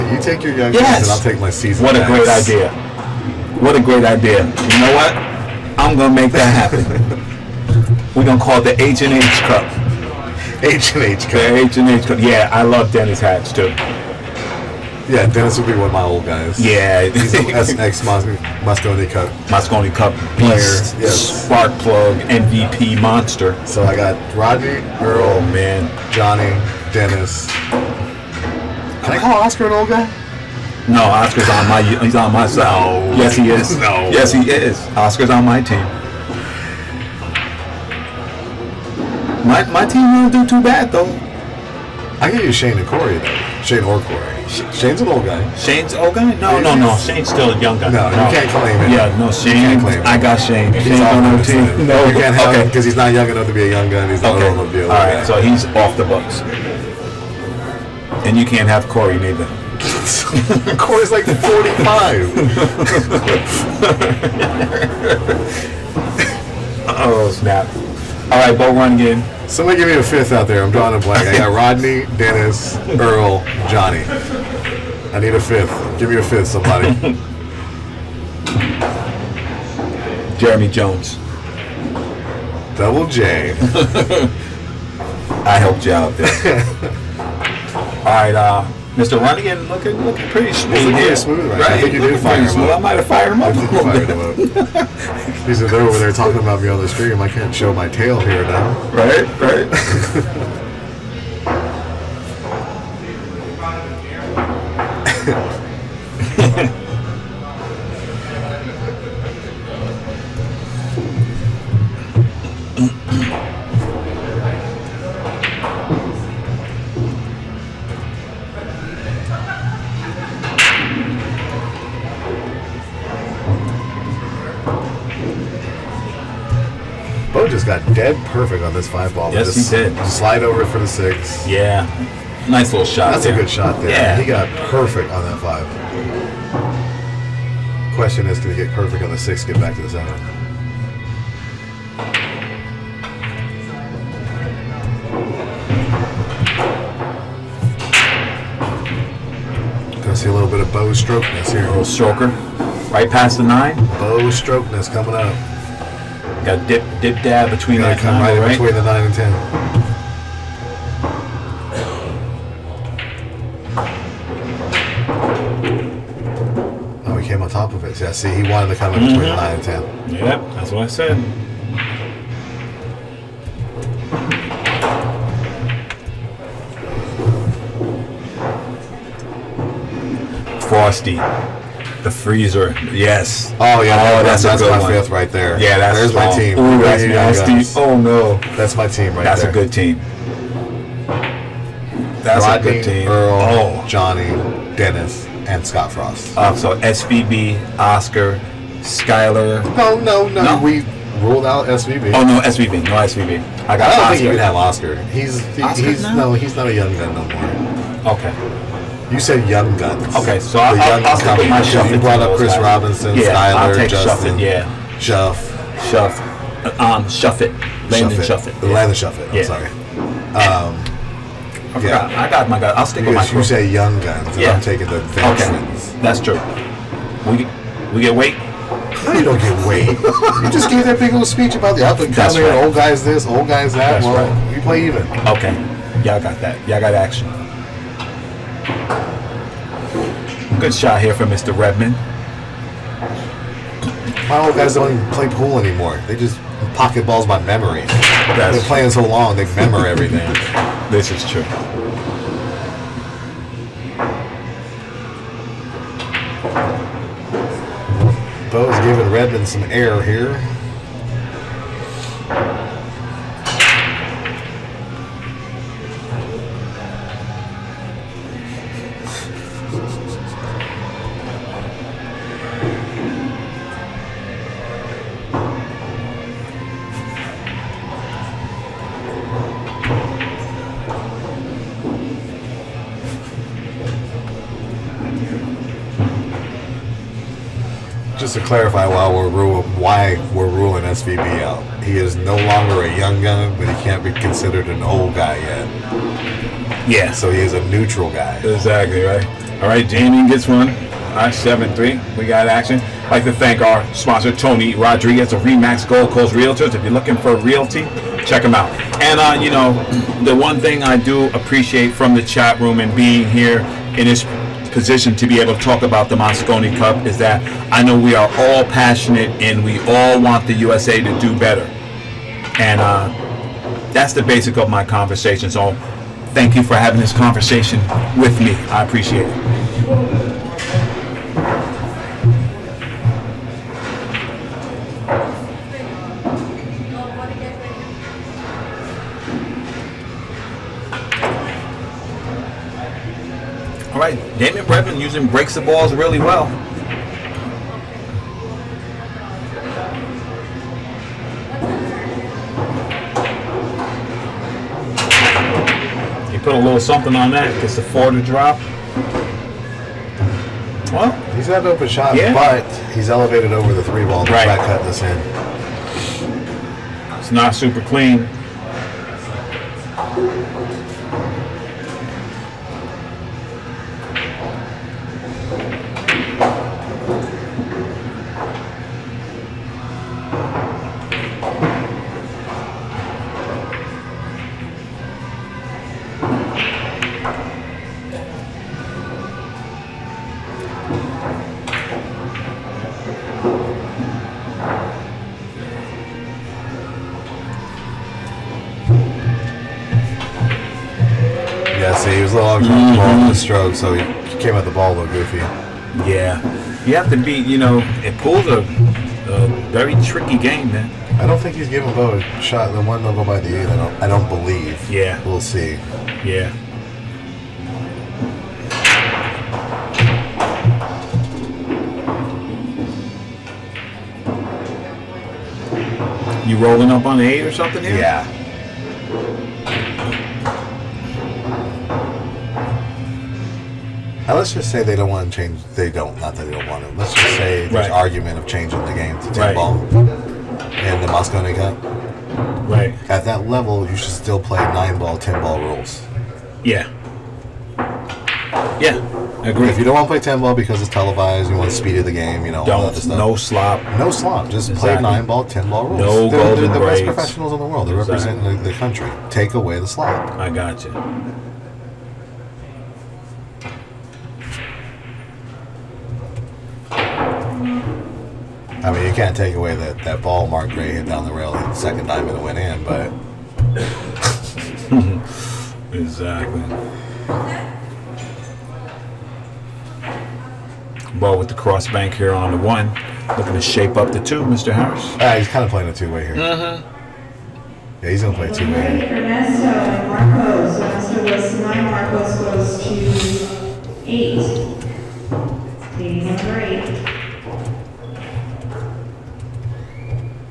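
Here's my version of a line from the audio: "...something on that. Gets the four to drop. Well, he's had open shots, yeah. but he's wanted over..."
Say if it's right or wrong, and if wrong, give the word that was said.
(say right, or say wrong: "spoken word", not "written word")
wrong: "elevated", not "wanted".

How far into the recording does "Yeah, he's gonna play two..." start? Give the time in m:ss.
8:08.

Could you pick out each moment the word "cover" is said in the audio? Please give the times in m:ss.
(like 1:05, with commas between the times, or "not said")
not said.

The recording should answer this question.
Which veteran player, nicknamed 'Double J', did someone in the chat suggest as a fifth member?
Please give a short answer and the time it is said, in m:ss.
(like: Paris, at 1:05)
Jeremy Jones, at 1:20.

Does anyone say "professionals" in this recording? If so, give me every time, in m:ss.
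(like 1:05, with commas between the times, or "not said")
7:37.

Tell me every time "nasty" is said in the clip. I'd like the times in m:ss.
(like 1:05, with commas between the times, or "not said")
3:07.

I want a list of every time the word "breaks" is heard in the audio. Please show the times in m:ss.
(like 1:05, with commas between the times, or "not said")
5:45.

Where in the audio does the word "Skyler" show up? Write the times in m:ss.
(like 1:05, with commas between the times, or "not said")
3:18, 3:33.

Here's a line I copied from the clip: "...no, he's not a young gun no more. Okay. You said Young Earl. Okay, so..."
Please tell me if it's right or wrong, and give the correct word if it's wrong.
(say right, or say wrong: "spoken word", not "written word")
wrong: "Guns", not "Earl".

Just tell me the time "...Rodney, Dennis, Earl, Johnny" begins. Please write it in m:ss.
1:11.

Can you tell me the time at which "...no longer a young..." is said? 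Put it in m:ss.
4:52.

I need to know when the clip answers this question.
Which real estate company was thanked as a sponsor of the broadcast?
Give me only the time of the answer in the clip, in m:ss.
5:05.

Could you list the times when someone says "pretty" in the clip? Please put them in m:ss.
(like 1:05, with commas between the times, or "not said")
1:30.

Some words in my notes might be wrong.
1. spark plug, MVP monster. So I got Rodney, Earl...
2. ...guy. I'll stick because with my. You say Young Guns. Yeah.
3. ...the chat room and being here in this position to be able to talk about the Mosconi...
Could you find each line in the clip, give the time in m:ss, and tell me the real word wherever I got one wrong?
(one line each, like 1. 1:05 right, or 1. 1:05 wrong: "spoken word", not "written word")
1. 0:21 right
2. 3:42 right
3. 5:12 right.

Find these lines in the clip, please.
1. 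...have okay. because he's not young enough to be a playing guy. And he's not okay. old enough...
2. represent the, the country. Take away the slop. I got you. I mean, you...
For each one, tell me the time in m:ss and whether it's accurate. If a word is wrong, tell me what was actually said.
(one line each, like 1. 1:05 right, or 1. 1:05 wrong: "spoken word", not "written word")
1. 0:52 wrong: "young", not "playing"
2. 7:38 right.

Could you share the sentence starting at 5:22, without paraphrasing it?
And uh, that's the basic of my conversation.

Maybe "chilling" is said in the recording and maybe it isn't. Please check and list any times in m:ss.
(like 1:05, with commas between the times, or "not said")
not said.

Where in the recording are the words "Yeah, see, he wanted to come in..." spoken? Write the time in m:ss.
2:47.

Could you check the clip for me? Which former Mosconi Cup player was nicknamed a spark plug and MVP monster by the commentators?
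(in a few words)
Dennis Hatch.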